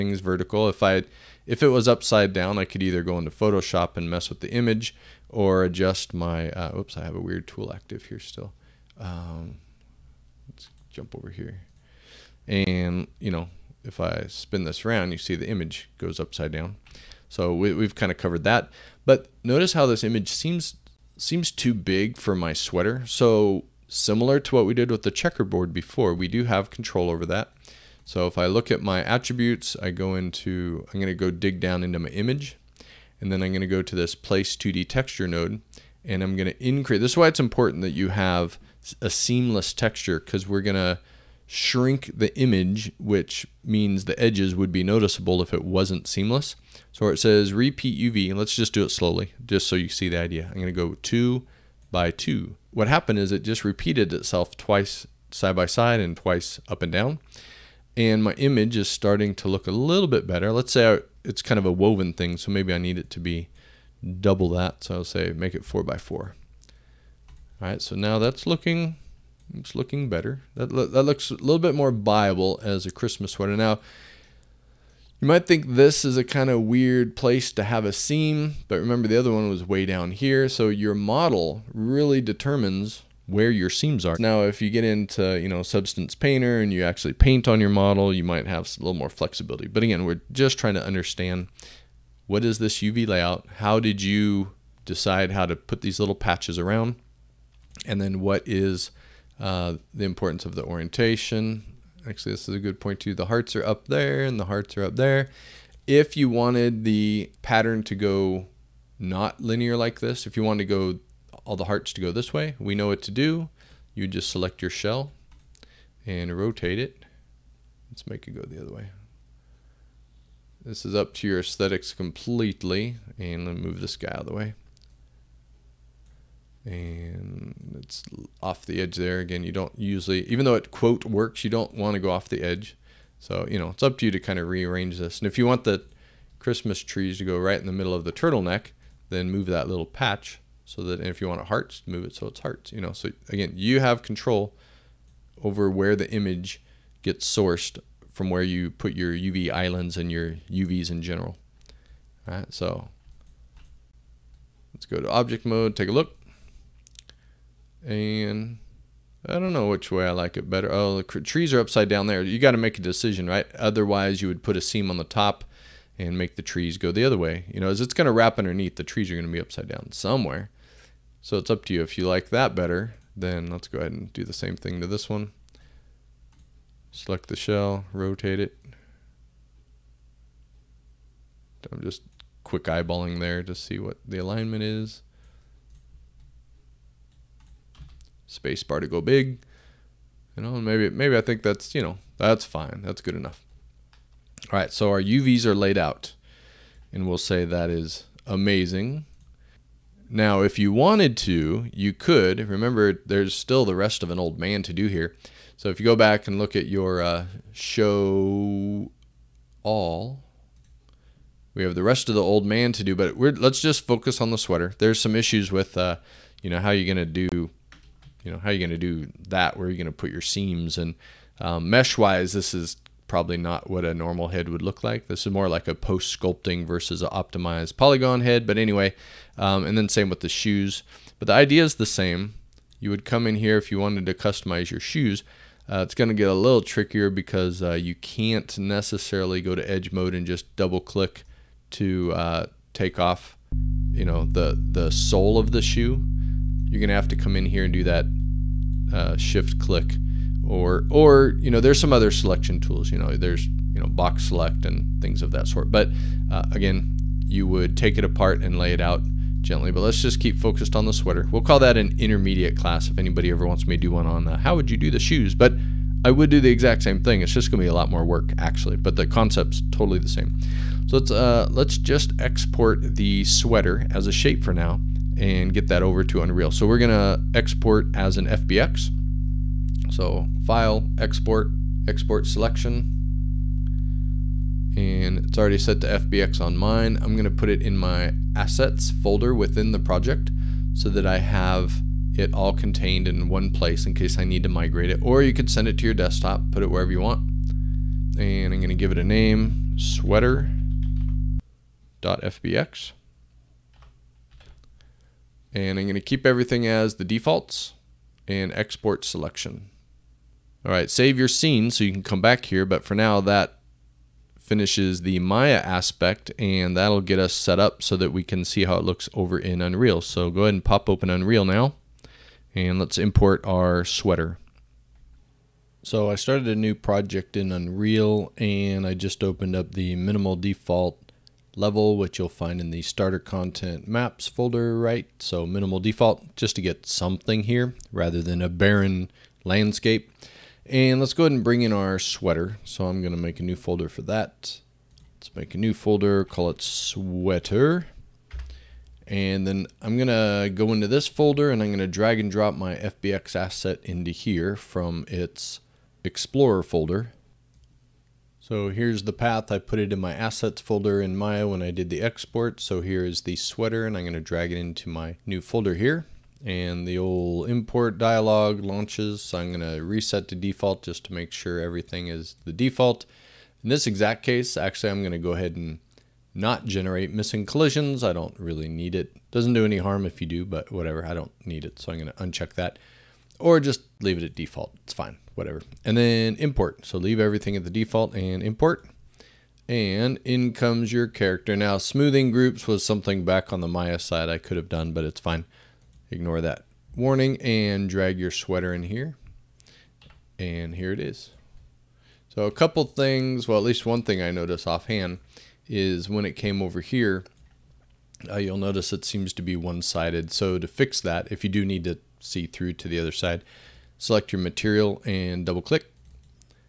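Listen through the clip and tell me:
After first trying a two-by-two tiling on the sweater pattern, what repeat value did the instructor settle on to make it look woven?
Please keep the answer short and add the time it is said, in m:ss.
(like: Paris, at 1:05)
4 by 4, at 1:05.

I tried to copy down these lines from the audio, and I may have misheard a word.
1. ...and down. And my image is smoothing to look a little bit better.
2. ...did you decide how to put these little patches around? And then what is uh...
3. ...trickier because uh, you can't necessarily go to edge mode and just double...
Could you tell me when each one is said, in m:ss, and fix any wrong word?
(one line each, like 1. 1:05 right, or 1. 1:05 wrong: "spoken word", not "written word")
1. 0:56 wrong: "starting", not "smoothing"
2. 1:33 right
3. 3:56 right.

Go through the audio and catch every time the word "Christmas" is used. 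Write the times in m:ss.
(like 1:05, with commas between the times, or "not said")
1:12, 2:16.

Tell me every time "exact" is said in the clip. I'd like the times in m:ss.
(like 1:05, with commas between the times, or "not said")
4:26, 6:13.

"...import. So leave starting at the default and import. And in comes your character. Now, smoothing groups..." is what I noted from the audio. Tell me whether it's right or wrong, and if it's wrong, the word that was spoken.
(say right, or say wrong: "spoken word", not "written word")
wrong: "everything", not "starting".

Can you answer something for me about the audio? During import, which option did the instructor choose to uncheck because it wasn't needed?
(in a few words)
generate missing collisions.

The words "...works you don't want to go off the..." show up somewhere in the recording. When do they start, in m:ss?
2:11.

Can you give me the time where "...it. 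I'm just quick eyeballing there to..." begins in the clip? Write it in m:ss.
2:58.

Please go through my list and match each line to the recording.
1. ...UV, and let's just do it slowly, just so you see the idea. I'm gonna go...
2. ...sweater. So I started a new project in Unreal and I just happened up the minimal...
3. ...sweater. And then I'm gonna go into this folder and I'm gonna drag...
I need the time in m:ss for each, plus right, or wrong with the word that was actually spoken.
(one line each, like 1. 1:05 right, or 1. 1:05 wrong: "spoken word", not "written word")
1. 0:48 right
2. 5:23 wrong: "opened", not "happened"
3. 5:46 right.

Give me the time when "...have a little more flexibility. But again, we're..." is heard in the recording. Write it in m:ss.
1:28.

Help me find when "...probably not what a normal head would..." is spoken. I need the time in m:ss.
3:43.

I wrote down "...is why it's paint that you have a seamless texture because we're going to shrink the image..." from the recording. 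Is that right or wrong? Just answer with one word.
wrong.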